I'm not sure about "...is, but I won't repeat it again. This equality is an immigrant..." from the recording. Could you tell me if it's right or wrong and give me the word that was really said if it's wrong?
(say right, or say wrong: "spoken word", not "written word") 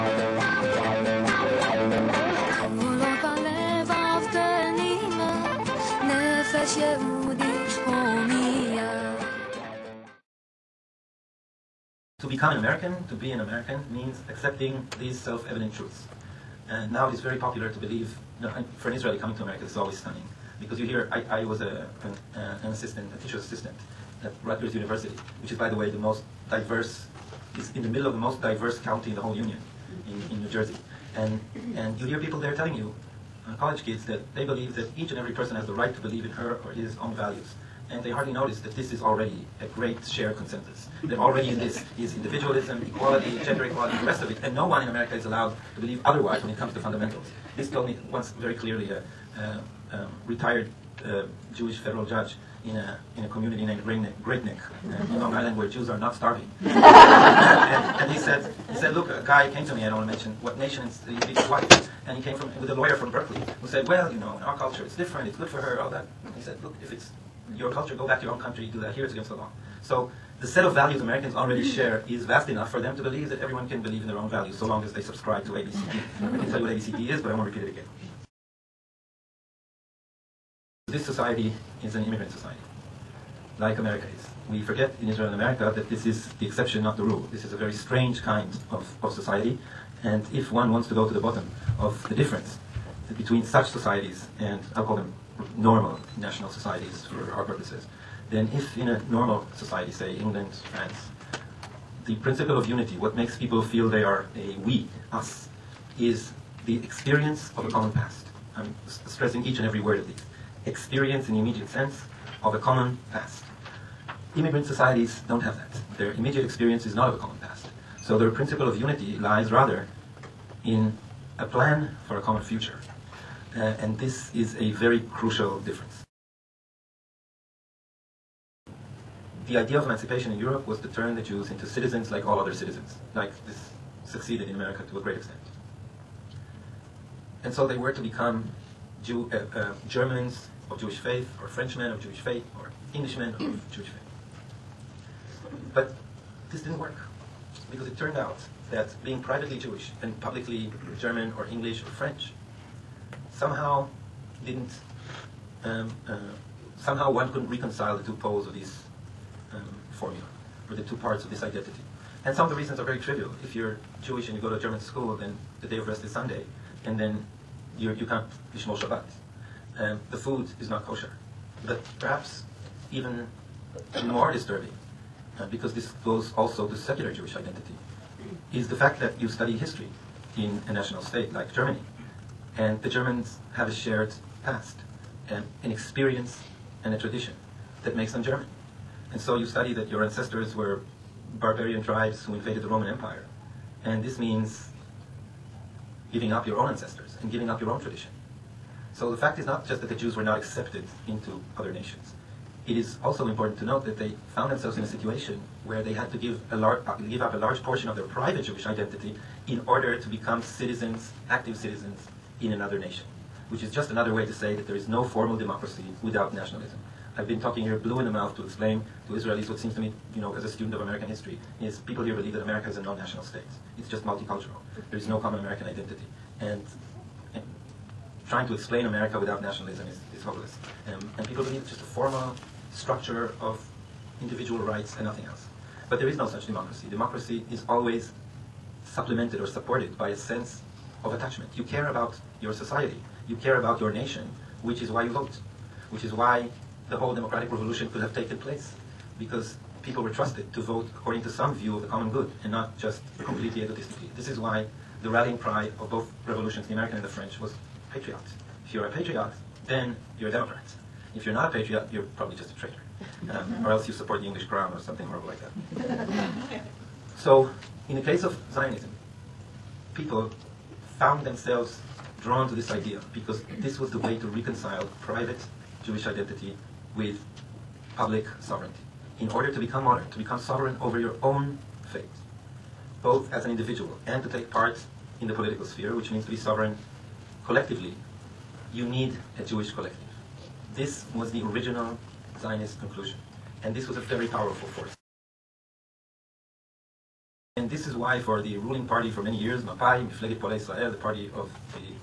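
wrong: "society", not "equality".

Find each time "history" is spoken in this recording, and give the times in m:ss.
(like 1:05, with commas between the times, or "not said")
2:59, 3:41.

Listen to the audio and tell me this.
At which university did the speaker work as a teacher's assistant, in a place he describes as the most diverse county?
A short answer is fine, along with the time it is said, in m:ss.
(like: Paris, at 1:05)
Rutgers University, at 0:24.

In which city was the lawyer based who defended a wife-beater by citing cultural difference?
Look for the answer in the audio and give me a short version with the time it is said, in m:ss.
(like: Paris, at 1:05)
Berkeley, at 1:03.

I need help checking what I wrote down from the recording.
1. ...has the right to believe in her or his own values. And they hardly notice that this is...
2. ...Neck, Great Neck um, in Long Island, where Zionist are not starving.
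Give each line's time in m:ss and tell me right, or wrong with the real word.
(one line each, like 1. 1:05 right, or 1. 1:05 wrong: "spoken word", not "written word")
1. 0:35 right
2. 0:53 wrong: "Jews", not "Zionist".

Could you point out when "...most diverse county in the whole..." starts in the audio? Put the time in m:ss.
0:28.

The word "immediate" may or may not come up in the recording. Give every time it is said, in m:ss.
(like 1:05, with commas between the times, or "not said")
1:51, 1:56.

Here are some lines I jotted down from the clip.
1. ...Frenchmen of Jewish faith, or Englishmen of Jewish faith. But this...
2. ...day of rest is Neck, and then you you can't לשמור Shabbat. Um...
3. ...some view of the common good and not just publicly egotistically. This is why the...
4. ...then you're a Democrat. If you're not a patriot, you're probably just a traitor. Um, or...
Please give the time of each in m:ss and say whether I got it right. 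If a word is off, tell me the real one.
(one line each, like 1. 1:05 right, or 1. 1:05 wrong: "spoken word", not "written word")
1. 2:21 right
2. 2:45 wrong: "Sunday", not "Neck"
3. 4:11 wrong: "completely", not "publicly"
4. 4:19 right.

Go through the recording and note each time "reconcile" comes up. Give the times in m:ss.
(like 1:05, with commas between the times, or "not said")
2:37, 4:34.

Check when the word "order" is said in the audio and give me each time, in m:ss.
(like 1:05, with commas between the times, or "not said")
3:29, 4:39.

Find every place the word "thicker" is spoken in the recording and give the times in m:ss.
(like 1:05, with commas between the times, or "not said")
not said.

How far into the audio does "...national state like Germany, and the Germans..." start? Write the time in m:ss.
3:00.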